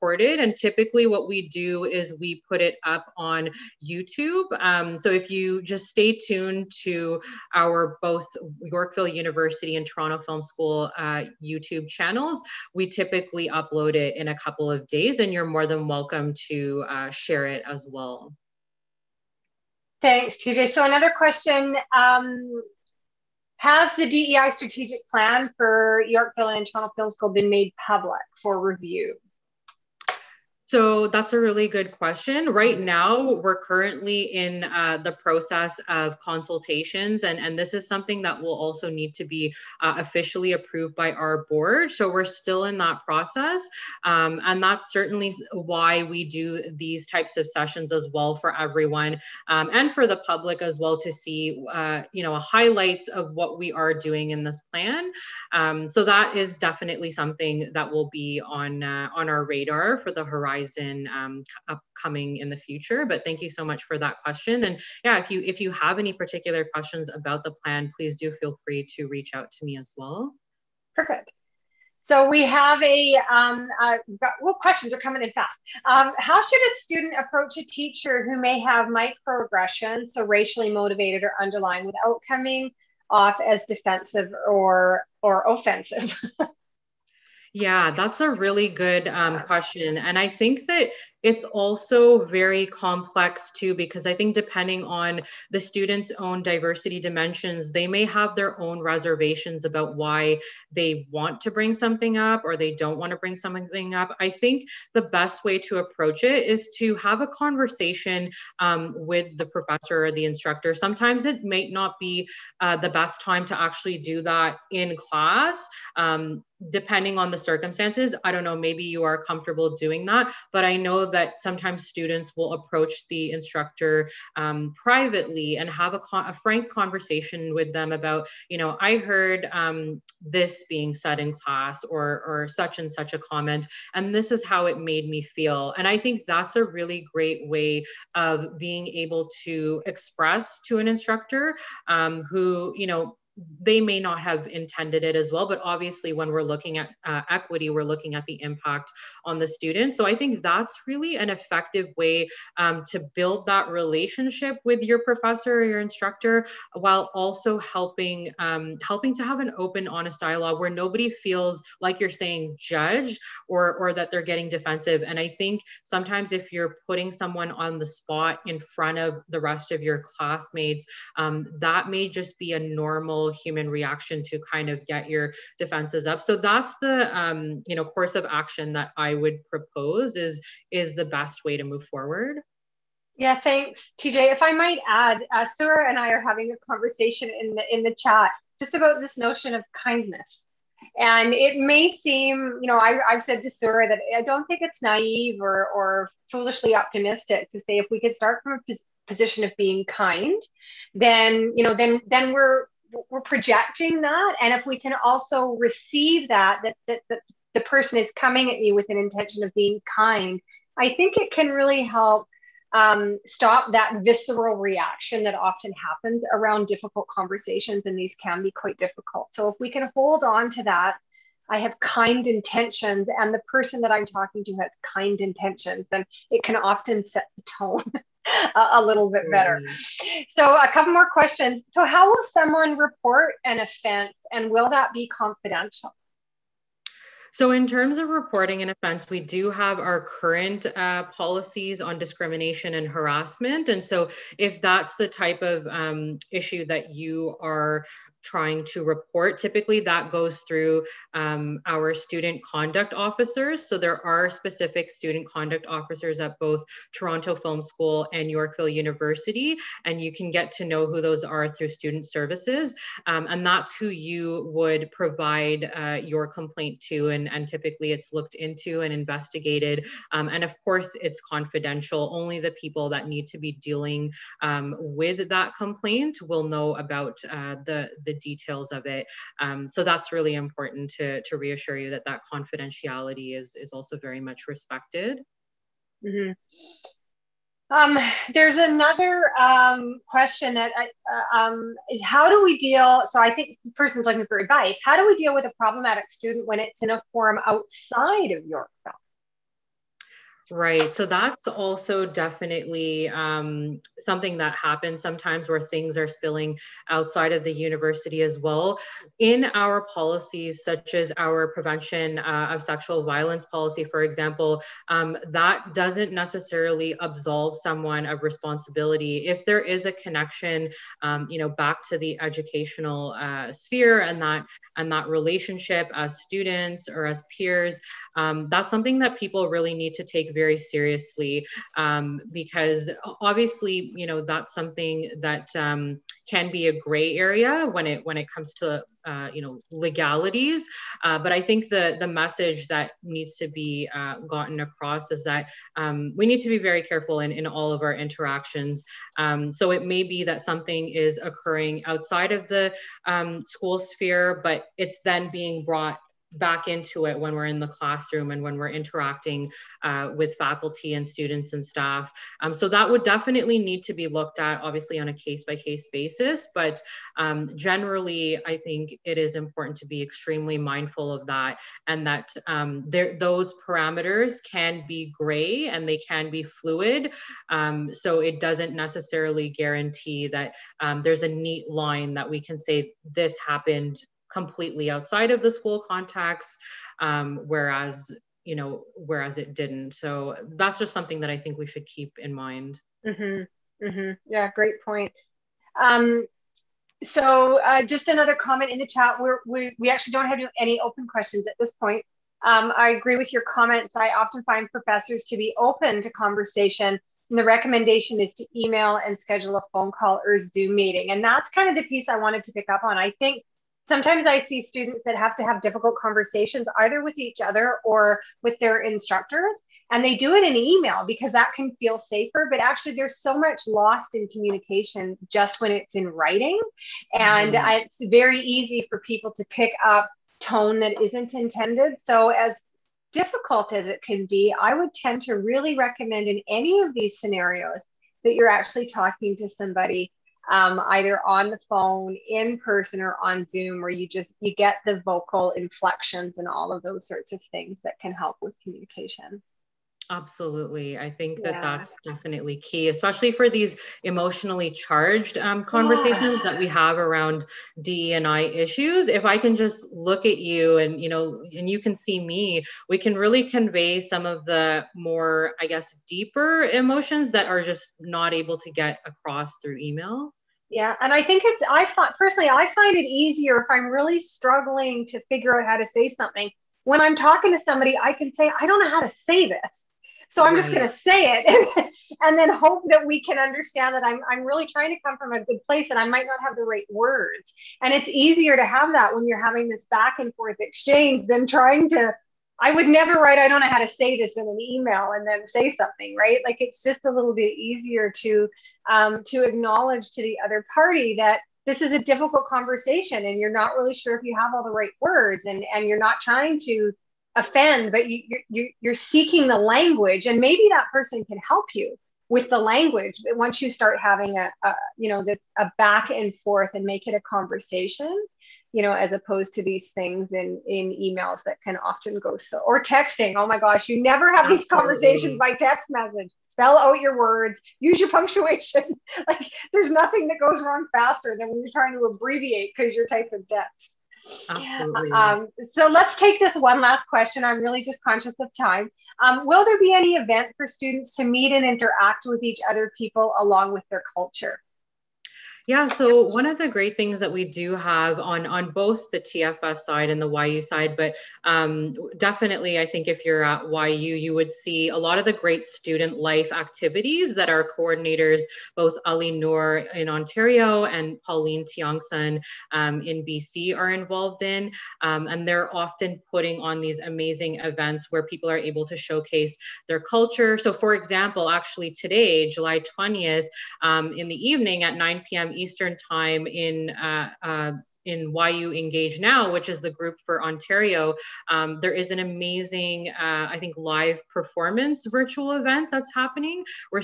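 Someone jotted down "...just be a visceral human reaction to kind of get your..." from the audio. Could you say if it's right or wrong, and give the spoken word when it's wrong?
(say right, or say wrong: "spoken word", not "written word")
wrong: "normal", not "visceral".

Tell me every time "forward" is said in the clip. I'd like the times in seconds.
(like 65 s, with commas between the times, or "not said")
181 s.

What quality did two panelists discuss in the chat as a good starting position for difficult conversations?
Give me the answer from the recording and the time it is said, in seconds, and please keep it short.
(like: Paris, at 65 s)
kindness, at 189 s.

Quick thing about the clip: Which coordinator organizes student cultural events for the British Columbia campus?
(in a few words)
Pauline Tiongson.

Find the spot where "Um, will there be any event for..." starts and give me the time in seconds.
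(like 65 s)
539 s.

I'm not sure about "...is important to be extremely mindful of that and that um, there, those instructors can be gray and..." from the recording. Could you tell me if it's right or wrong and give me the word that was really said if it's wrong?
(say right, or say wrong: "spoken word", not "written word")
wrong: "parameters", not "instructors".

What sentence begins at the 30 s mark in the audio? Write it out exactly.
So that's a really good question.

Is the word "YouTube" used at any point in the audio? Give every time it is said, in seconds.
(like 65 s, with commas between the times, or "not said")
3 s, 11 s.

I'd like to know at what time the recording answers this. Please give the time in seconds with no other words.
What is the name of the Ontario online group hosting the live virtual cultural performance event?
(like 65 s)
578 s.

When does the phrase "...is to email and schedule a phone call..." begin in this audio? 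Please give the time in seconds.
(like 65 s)
408 s.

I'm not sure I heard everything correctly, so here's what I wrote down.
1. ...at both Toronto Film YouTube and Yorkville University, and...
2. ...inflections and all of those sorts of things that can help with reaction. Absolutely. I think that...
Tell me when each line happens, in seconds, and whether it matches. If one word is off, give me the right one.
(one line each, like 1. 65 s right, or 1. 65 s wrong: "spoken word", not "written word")
1. 256 s wrong: "School", not "YouTube"
2. 445 s wrong: "communication", not "reaction".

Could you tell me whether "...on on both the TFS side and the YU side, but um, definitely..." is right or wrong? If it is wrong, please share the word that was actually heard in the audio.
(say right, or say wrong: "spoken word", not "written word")
right.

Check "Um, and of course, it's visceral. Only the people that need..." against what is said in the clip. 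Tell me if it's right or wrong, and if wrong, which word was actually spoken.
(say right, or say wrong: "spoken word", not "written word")
wrong: "confidential", not "visceral".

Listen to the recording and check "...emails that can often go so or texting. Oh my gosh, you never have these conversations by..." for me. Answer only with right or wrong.
right.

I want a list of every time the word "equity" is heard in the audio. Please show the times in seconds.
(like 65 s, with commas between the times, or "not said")
147 s.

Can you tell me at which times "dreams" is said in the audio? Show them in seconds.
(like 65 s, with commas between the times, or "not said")
not said.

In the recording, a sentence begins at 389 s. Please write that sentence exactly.
So that's just something that I think we should keep in mind.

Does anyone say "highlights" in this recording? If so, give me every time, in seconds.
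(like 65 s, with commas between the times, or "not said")
52 s.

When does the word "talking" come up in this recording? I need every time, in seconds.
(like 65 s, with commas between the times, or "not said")
224 s, 438 s, 477 s.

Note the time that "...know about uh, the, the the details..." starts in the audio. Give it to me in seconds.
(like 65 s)
276 s.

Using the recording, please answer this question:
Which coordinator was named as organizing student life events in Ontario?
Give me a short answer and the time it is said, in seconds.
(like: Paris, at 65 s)
Ali Noor, at 559 s.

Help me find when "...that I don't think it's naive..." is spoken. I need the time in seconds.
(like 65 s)
193 s.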